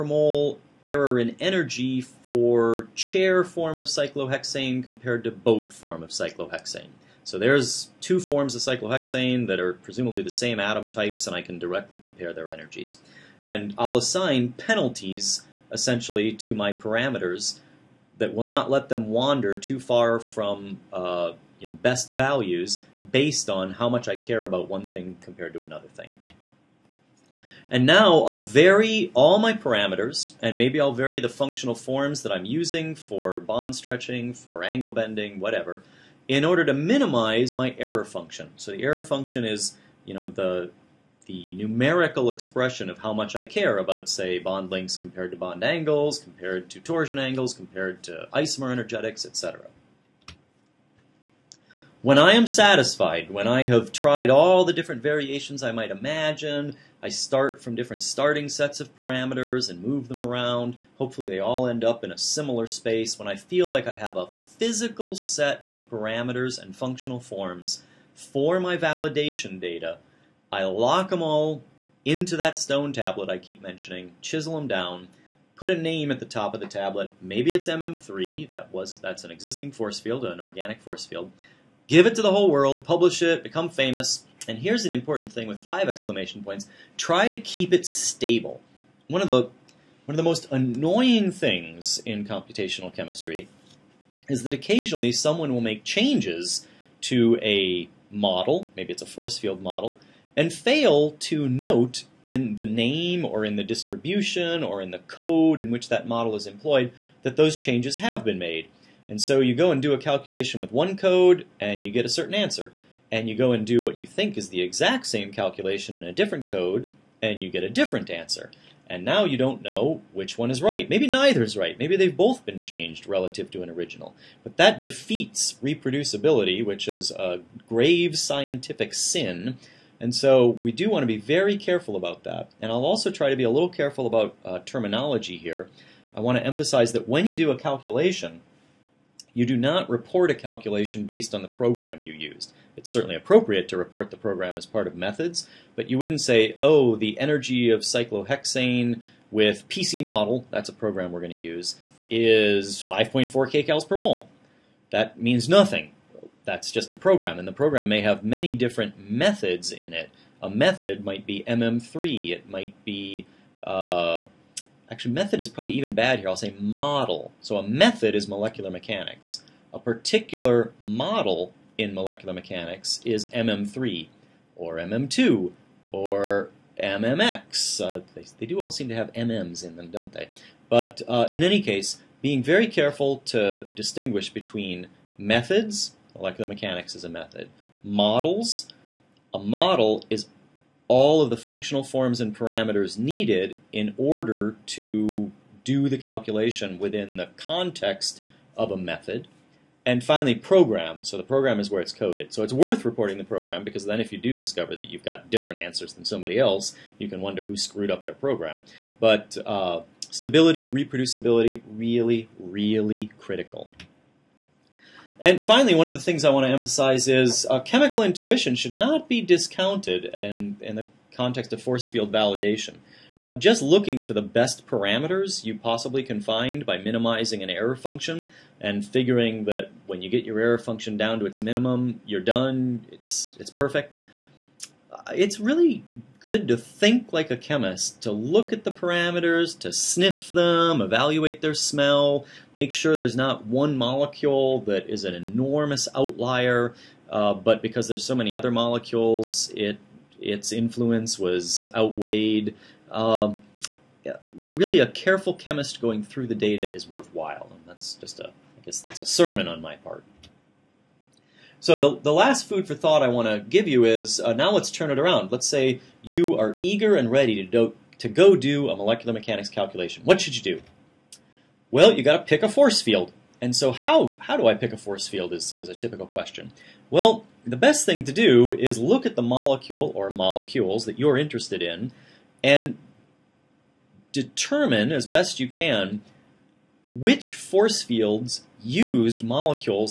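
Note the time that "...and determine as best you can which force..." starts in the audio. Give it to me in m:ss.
4:42.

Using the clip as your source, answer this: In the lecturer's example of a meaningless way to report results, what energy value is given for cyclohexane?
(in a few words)
5.4 kcal/mol.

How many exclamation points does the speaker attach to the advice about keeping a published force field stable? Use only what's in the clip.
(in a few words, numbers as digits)
5.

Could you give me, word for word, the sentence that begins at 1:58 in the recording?
And now you don't know which one is right.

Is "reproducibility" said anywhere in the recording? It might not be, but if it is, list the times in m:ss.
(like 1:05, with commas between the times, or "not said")
2:05, 3:30.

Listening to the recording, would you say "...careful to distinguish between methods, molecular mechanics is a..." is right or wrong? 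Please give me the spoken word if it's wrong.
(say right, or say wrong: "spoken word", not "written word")
right.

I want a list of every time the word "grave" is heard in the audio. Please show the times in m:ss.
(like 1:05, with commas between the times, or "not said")
2:07.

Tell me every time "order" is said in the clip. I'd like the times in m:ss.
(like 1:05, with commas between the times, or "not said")
0:36, 3:13.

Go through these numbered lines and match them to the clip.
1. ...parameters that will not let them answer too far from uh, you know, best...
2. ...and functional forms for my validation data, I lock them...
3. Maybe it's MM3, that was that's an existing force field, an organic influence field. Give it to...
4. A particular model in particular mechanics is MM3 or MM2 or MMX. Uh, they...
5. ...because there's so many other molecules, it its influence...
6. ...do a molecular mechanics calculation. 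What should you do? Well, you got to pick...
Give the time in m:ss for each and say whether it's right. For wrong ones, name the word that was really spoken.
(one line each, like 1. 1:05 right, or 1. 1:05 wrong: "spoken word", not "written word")
1. 0:16 wrong: "wander", not "answer"
2. 1:06 right
3. 1:17 wrong: "force", not "influence"
4. 2:49 wrong: "molecular", not "particular"
5. 4:07 right
6. 4:28 right.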